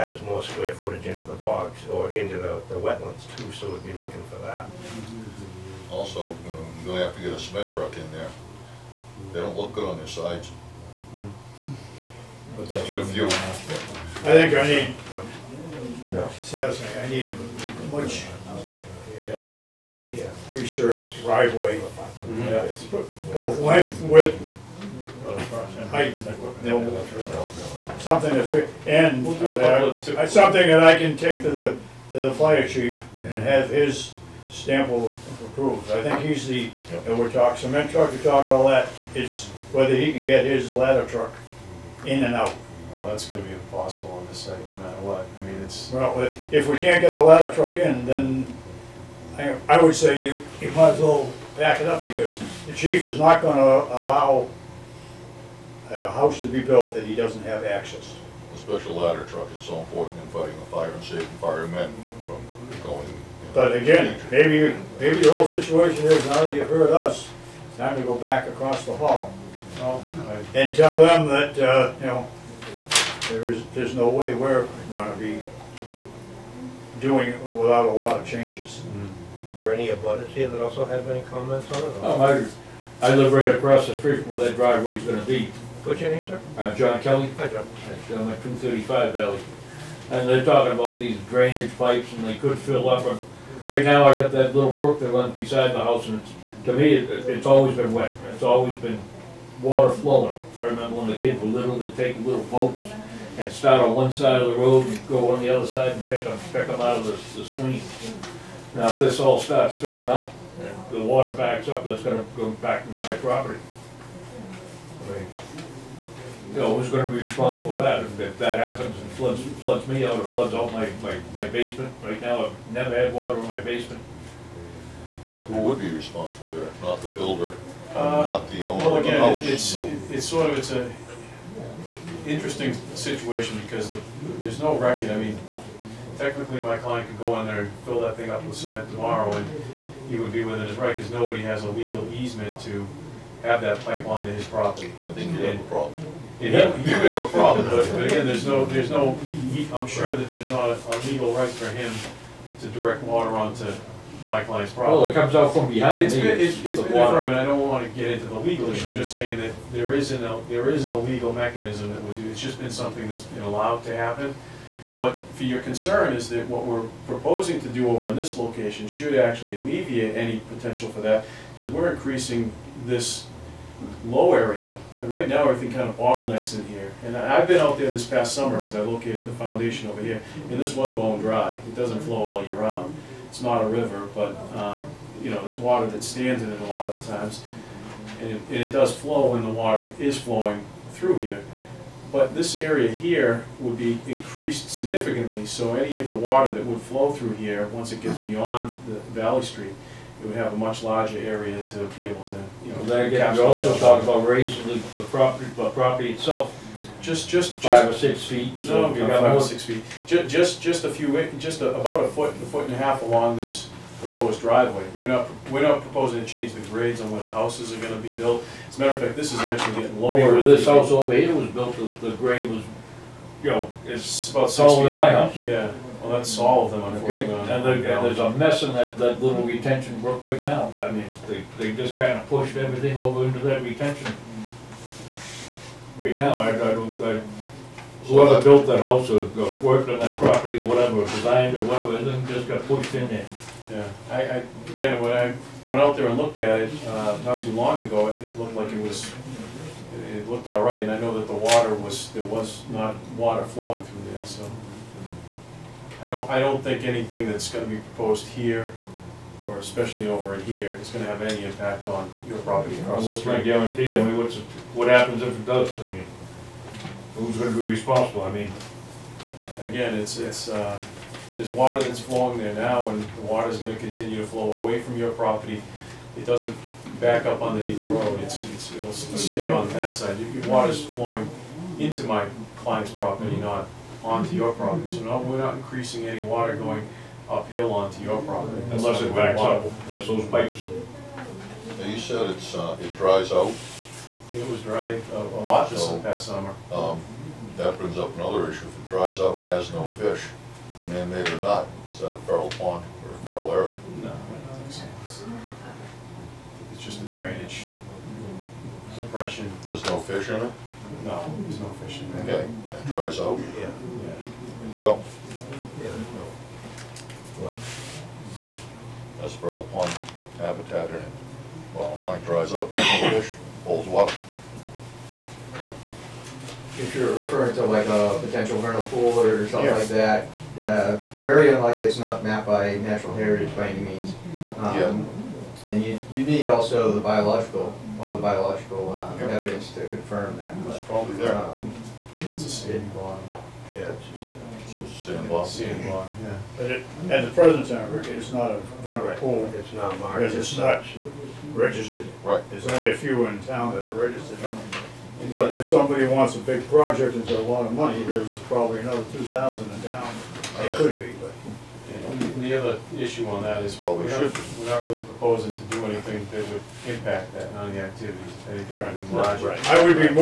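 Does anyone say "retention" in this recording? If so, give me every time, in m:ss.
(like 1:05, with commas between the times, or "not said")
3:49, 3:53.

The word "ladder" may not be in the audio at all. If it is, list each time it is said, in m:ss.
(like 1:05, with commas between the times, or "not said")
0:40, 0:47, 0:58.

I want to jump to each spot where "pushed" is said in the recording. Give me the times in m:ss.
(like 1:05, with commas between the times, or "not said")
3:52, 4:02.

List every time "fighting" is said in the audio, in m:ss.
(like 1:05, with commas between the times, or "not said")
1:00.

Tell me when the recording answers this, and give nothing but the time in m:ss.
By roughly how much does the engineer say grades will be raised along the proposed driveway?
3:32.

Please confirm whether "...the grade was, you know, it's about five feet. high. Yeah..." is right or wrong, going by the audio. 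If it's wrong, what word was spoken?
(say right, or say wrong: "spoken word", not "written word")
wrong: "six", not "five".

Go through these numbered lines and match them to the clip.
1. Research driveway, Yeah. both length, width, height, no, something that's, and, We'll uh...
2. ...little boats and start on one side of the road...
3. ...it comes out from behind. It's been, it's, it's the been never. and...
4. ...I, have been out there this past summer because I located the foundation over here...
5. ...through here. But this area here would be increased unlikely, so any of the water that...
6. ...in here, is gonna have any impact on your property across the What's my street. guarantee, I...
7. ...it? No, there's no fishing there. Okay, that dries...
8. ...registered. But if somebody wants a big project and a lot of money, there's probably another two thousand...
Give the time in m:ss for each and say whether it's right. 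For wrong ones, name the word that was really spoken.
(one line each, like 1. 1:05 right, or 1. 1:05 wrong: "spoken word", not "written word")
1. 0:20 right
2. 1:42 right
3. 2:35 wrong: "water", not "never"
4. 2:57 right
5. 3:10 wrong: "significantly", not "unlikely"
6. 4:20 right
7. 5:10 right
8. 5:53 right.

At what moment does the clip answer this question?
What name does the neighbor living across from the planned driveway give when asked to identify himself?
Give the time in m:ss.
1:26.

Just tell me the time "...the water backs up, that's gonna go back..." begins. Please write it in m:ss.
1:50.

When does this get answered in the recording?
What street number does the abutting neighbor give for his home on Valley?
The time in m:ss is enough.
1:28.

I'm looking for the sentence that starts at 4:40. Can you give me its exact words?
Your your water's flowing into my client's property, not onto your property.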